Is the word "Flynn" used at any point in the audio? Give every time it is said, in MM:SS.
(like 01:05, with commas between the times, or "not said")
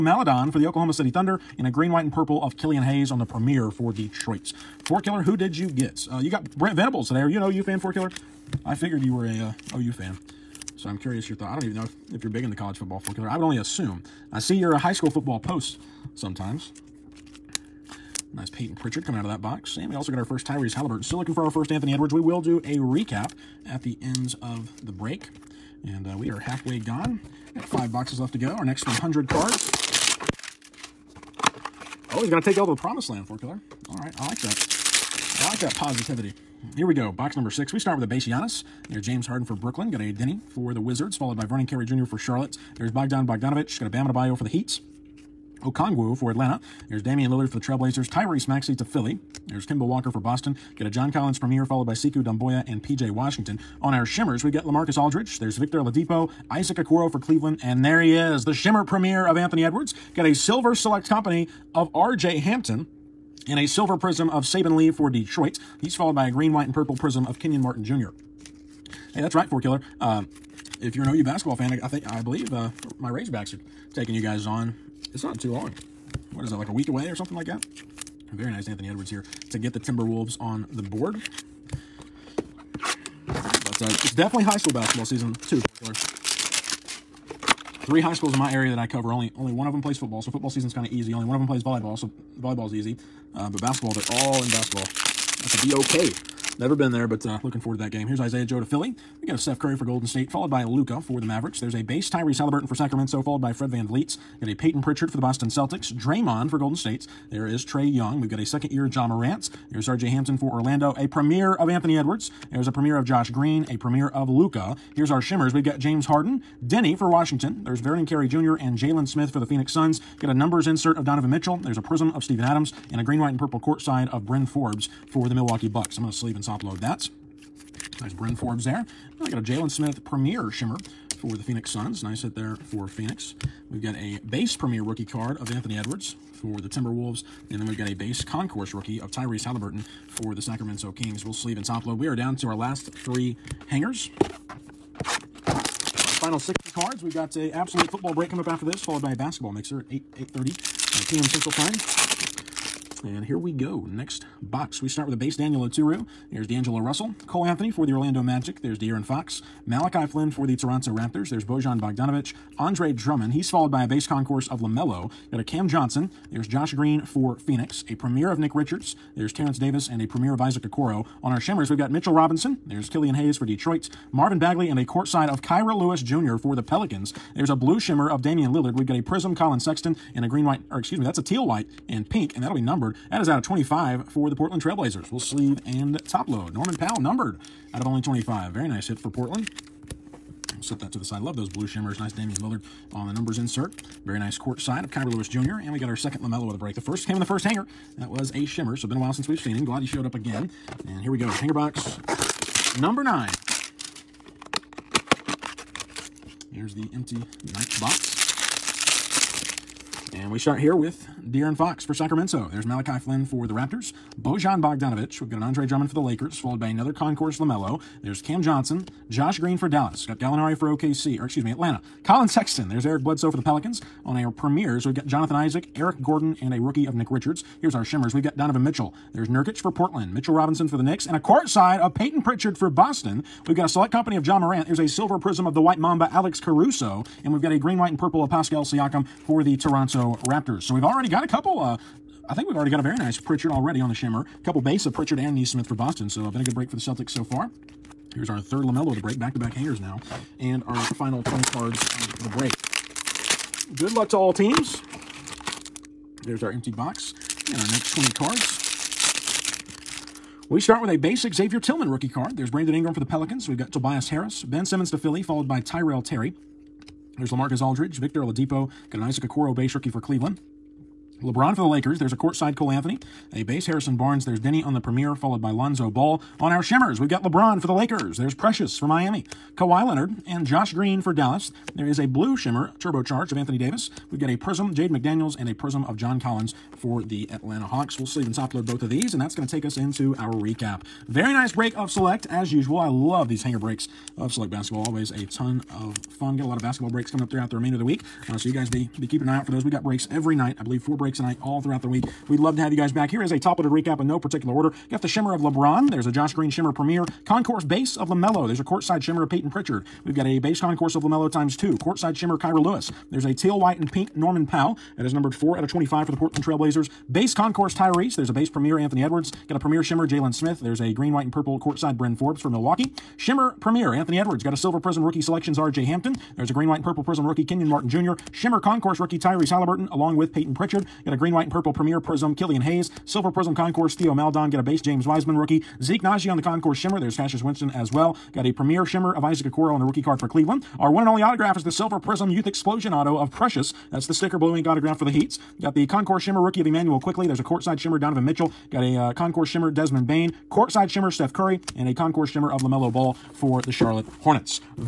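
02:40, 03:32.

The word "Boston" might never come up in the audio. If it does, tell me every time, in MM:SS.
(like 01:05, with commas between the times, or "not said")
00:50, 01:45, 03:52, 04:05.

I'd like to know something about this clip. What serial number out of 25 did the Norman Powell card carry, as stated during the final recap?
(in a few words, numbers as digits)
4.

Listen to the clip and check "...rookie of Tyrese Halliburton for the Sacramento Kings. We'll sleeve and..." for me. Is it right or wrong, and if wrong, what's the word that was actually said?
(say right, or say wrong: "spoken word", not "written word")
right.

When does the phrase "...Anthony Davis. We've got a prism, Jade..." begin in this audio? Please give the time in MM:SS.
04:43.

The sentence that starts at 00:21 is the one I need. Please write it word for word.
Still looking for our first Anthony Edwards.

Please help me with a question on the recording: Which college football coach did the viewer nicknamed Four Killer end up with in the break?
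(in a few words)
Brent Venables.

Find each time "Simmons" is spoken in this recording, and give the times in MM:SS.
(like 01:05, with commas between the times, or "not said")
04:24.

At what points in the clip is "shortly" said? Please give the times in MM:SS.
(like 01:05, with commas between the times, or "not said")
not said.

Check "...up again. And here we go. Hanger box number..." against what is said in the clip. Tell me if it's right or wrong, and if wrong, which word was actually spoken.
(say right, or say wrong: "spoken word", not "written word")
right.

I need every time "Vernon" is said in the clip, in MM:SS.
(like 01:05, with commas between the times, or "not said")
00:41, 01:57.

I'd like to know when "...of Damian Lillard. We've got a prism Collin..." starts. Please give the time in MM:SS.
02:58.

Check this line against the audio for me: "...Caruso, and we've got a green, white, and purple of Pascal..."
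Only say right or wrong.
right.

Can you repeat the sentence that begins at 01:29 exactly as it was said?
Only only one of them plays football, so football season's kind of easy.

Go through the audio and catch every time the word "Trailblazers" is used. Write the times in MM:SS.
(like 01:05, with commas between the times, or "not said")
00:47, 03:04, 05:16.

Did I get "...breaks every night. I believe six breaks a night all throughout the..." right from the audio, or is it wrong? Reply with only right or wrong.
wrong.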